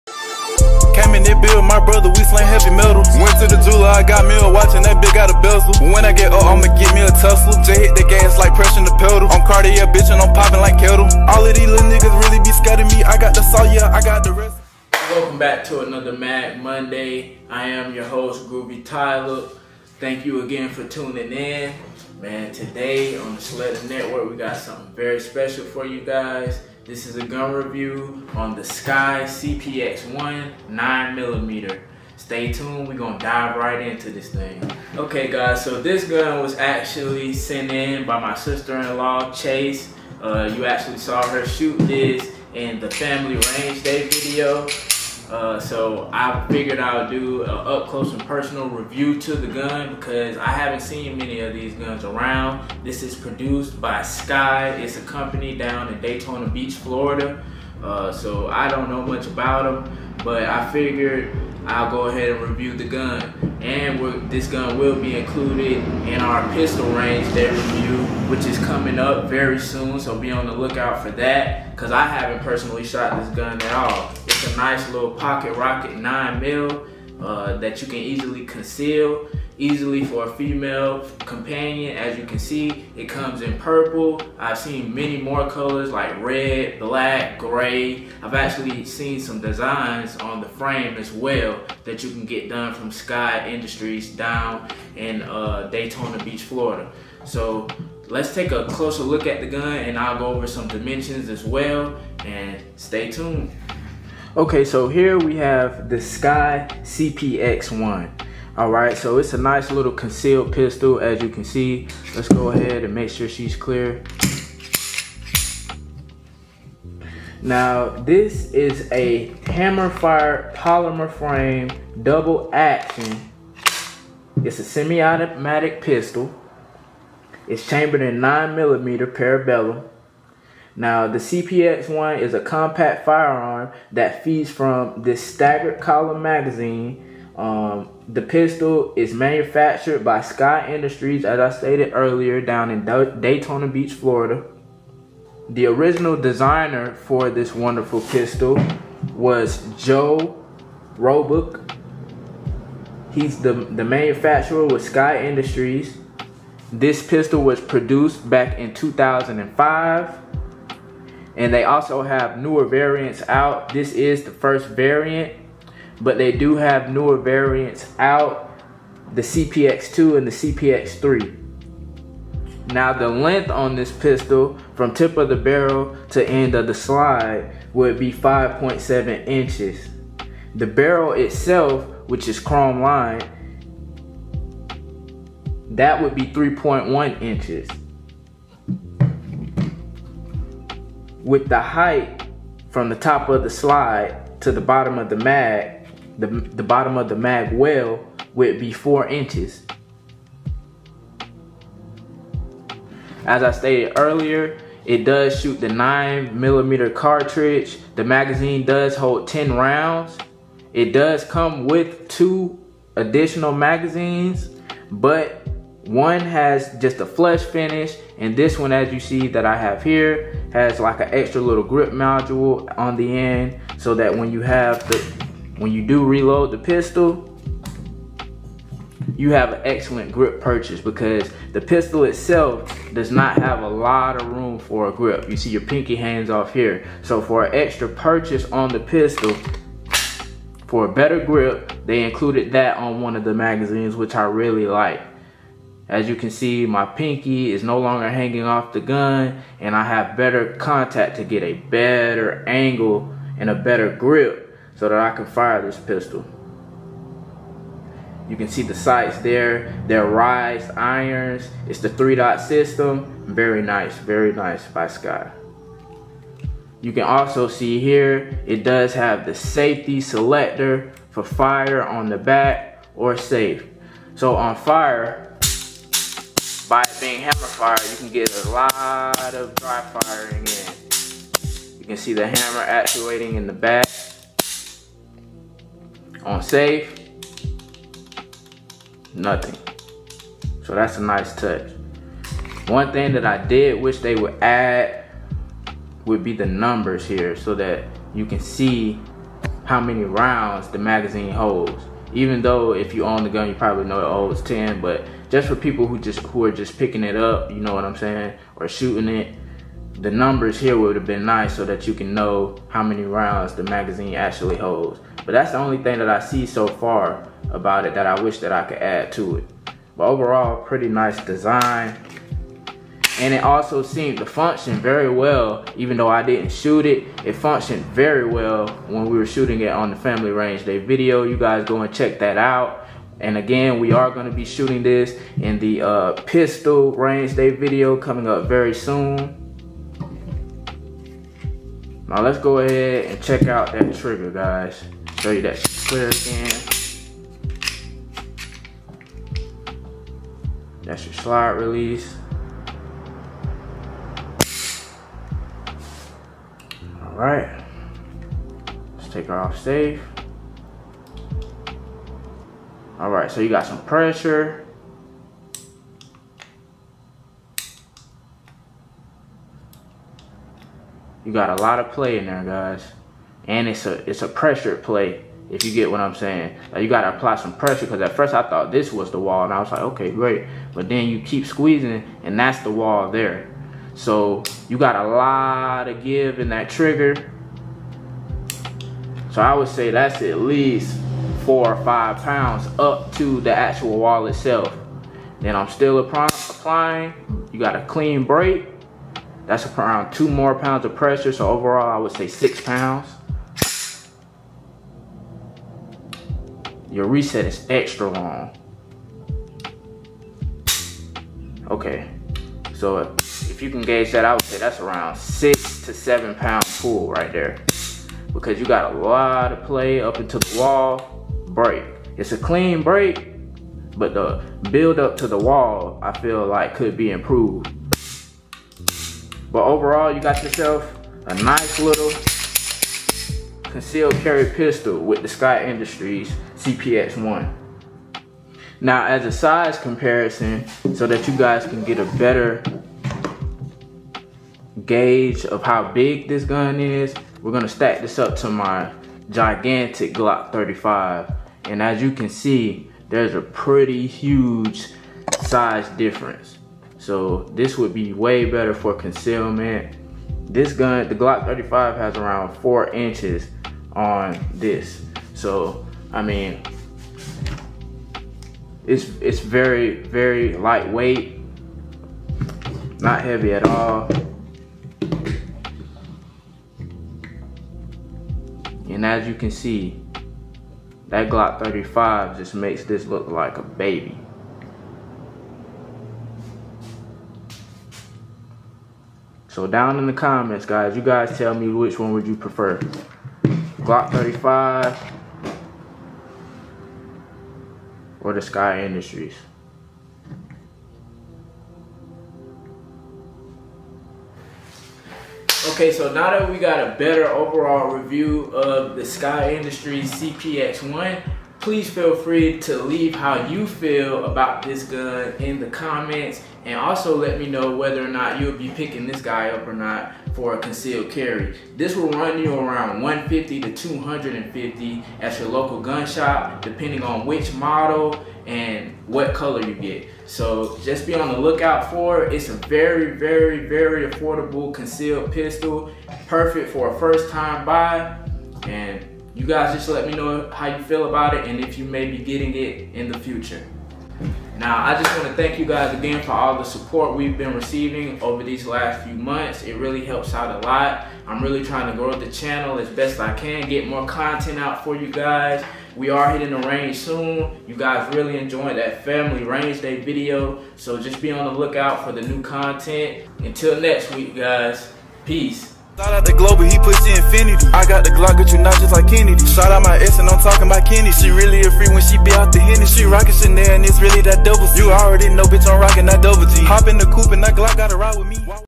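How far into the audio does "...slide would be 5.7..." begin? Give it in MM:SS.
02:56.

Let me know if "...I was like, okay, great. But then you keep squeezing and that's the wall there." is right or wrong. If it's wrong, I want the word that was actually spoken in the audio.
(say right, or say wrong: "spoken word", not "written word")
right.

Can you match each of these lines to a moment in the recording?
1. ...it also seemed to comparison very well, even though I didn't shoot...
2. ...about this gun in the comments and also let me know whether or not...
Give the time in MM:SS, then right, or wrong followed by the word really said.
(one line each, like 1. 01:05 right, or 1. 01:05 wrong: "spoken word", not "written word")
1. 05:23 wrong: "function", not "comparison"
2. 08:34 right.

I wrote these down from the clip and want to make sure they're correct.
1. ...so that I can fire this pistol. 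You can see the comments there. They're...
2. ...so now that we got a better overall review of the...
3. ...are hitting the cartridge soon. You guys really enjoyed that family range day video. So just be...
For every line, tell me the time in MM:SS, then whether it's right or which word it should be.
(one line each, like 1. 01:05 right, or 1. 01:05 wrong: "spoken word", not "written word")
1. 04:14 wrong: "sights", not "comments"
2. 08:25 right
3. 09:16 wrong: "range", not "cartridge".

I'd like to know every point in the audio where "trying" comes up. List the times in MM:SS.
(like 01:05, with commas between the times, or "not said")
09:11.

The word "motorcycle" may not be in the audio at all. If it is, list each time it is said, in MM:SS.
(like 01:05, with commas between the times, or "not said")
not said.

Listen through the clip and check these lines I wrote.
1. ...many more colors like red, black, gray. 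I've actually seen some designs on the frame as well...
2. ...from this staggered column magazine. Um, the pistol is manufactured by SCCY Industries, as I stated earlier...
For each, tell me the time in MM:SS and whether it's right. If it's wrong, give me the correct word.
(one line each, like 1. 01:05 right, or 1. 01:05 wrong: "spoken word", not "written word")
1. 01:24 right
2. 02:14 right.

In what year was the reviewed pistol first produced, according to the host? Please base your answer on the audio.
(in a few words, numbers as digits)
2005.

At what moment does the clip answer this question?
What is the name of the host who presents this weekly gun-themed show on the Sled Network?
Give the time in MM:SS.
00:18.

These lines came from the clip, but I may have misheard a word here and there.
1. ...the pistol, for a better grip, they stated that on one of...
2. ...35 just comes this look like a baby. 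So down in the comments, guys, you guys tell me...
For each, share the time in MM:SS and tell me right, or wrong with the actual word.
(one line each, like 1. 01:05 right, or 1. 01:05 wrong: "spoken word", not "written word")
1. 03:58 wrong: "included", not "stated"
2. 08:01 wrong: "makes", not "comes".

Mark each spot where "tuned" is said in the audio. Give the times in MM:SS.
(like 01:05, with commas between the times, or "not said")
00:32, 01:43.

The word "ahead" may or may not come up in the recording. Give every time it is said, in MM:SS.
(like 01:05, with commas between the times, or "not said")
01:02, 01:52, 05:42.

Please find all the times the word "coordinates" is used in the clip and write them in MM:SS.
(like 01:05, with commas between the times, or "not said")
not said.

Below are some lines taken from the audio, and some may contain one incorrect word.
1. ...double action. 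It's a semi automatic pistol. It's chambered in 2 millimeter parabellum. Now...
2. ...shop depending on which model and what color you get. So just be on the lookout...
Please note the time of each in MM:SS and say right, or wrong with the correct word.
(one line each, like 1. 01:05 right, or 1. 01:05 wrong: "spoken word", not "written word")
1. 02:02 wrong: "9", not "2"
2. 08:46 right.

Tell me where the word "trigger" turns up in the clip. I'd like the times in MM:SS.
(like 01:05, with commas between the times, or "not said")
05:43, 06:26.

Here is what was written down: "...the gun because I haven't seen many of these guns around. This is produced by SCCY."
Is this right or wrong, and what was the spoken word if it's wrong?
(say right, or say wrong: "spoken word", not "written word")
right.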